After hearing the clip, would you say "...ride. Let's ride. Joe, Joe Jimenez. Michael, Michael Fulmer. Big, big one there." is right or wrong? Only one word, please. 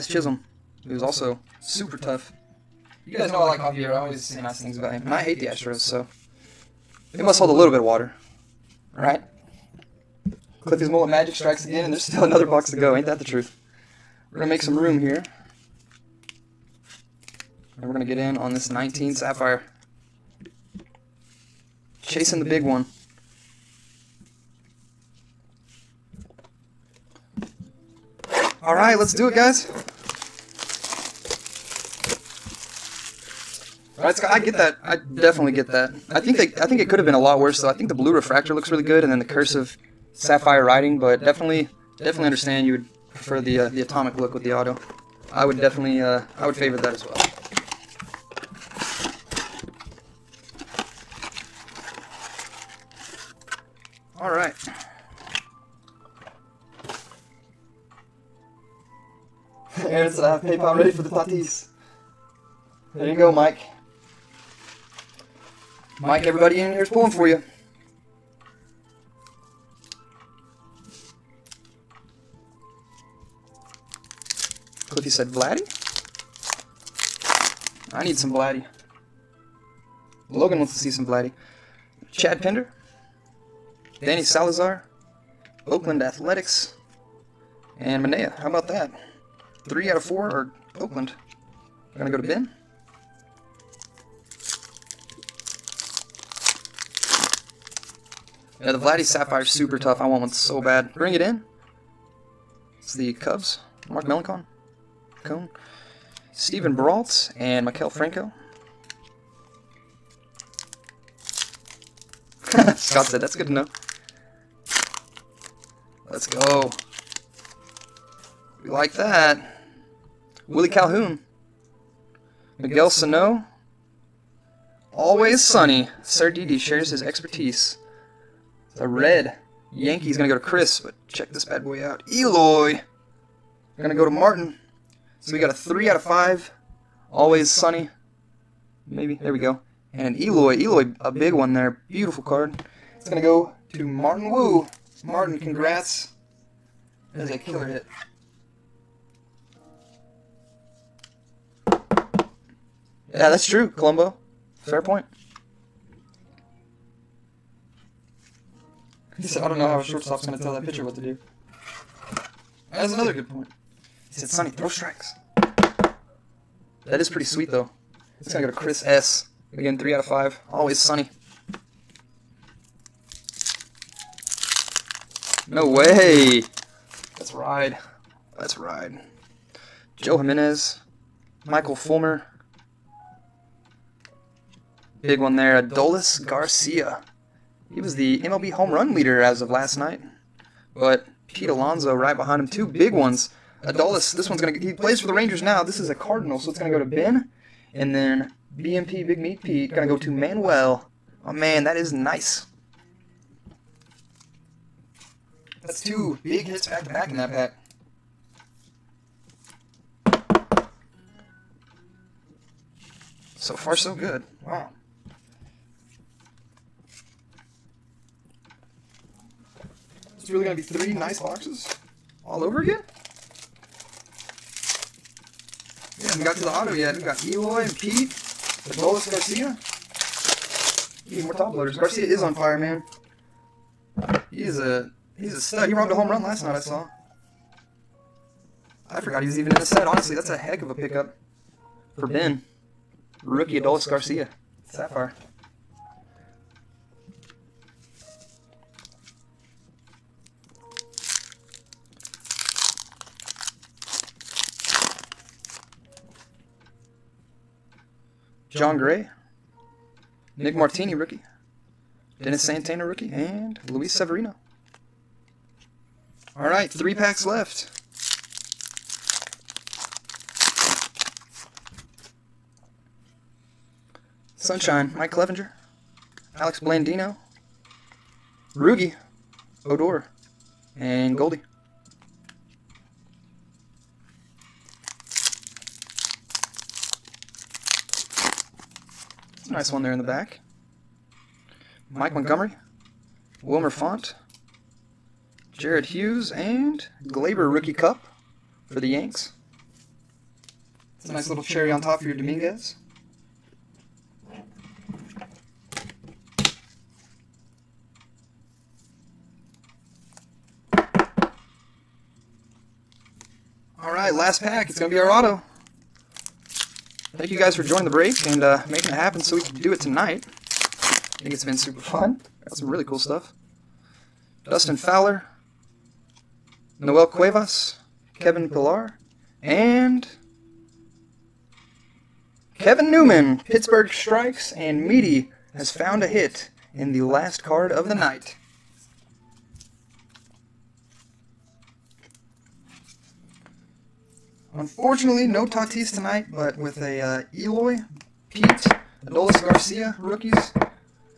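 right.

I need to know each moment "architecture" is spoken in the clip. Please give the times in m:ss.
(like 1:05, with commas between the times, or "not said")
not said.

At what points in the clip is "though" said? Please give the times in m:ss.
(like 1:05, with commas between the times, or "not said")
0:37, 2:47.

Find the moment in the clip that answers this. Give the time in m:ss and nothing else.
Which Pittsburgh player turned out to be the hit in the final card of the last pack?
5:32.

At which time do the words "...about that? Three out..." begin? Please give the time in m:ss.
1:28.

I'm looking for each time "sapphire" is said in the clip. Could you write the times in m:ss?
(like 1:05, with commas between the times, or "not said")
0:19, 0:40, 4:04.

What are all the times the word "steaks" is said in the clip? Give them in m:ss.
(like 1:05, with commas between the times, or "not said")
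not said.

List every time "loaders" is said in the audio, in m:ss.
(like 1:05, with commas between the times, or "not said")
3:51.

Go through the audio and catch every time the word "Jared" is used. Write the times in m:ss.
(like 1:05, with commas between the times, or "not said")
4:55.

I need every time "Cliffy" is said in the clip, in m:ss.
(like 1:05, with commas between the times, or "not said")
0:10, 1:14.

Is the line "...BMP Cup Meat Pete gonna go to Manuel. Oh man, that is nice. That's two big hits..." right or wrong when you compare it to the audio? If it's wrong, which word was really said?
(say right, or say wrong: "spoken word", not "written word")
wrong: "Big", not "Cup".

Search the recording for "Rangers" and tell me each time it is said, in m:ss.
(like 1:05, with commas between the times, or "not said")
3:15.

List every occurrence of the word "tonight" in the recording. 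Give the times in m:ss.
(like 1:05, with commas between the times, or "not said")
5:19, 5:45.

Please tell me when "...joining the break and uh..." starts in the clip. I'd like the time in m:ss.
5:17.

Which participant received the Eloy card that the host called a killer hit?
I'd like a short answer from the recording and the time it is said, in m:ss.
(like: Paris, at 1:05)
Martin Wu, at 2:23.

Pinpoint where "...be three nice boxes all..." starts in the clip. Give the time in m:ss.
3:40.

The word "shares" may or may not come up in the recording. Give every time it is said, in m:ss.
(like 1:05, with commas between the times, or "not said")
2:06.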